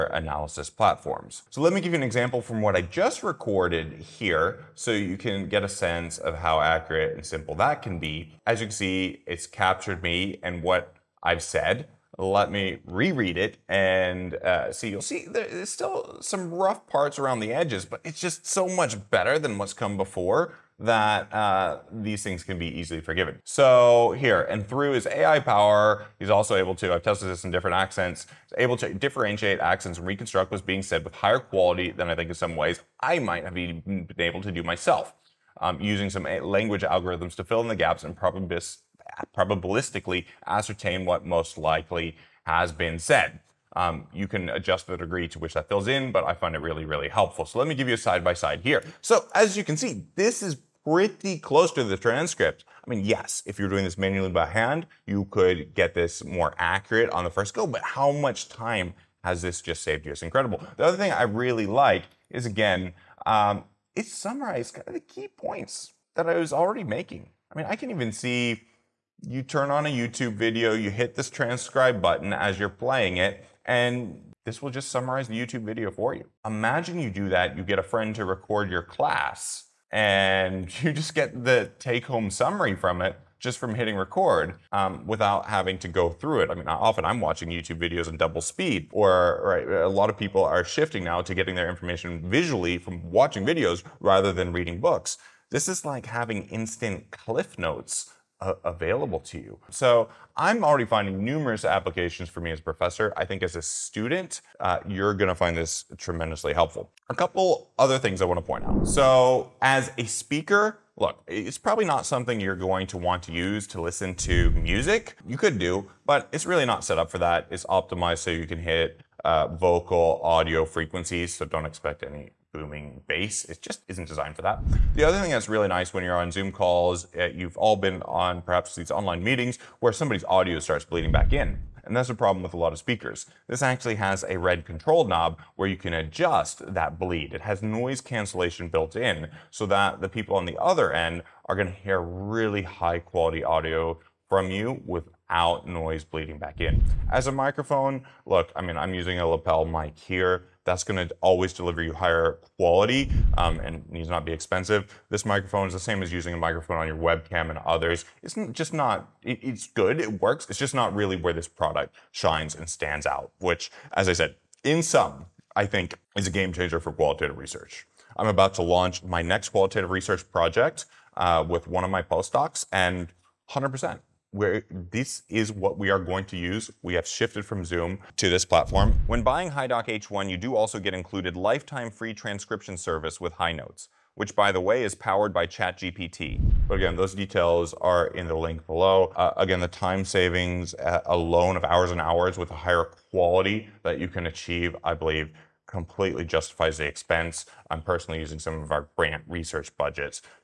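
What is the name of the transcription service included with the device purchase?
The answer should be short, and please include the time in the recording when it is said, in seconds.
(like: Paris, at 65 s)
HiNotes, at 183 s.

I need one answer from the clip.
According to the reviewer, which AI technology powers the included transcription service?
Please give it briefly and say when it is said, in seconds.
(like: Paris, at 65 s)
ChatGPT, at 185 s.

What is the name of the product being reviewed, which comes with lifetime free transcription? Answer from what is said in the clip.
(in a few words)
HiDock H1.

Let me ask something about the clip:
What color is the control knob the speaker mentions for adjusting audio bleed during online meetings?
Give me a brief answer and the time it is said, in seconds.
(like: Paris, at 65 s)
Red, at 134 s.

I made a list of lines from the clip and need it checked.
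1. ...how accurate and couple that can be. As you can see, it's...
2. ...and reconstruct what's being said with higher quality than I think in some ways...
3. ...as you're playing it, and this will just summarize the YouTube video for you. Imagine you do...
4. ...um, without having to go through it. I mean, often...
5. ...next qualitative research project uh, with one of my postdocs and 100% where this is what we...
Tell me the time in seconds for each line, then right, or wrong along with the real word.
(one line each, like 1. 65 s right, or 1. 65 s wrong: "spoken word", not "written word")
1. 6 s wrong: "simple", not "couple"
2. 29 s right
3. 72 s right
4. 84 s right
5. 169 s right.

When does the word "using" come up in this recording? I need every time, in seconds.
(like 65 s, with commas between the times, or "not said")
35 s, 148 s, 156 s, 198 s.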